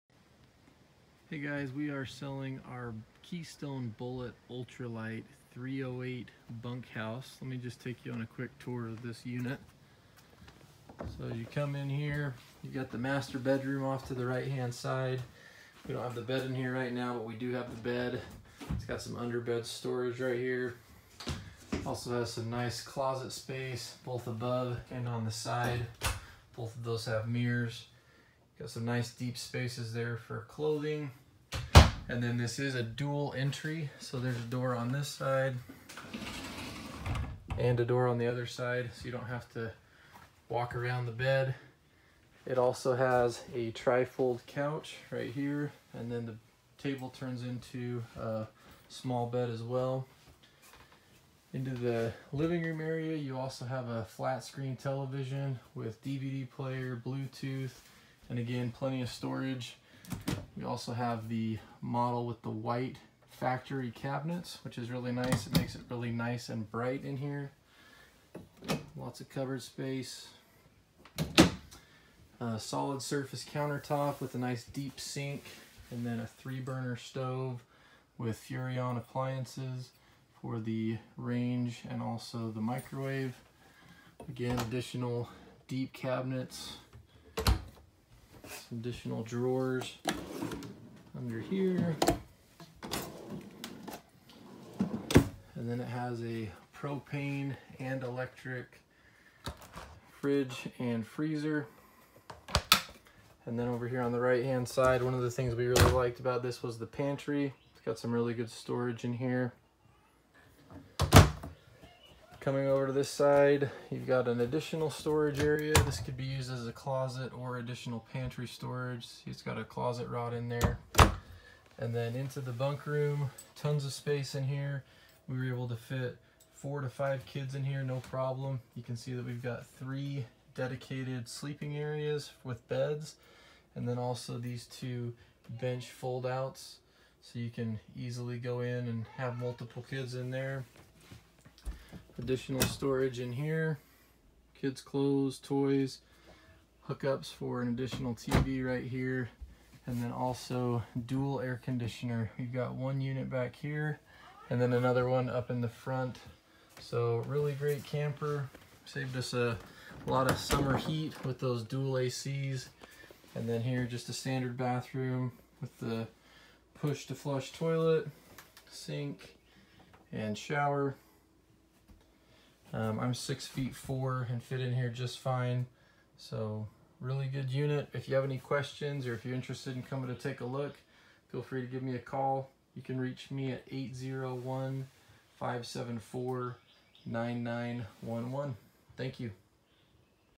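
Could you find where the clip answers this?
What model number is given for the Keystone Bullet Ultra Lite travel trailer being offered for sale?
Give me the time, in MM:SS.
00:05.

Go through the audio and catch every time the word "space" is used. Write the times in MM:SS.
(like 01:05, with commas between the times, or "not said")
00:23, 00:29, 01:09, 02:03.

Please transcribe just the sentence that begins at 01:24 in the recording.
Again, additional deep cabinets some additional drawers under here.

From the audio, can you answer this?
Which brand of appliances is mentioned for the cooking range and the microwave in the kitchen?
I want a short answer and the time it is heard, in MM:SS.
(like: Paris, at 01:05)
Furrion, at 01:18.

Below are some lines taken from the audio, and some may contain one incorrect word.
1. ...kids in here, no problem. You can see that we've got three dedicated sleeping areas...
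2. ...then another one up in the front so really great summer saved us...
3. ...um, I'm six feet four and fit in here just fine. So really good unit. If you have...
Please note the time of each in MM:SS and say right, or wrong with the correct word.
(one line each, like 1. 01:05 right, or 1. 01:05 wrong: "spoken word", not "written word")
1. 02:07 right
2. 02:34 wrong: "camper", not "summer"
3. 02:52 right.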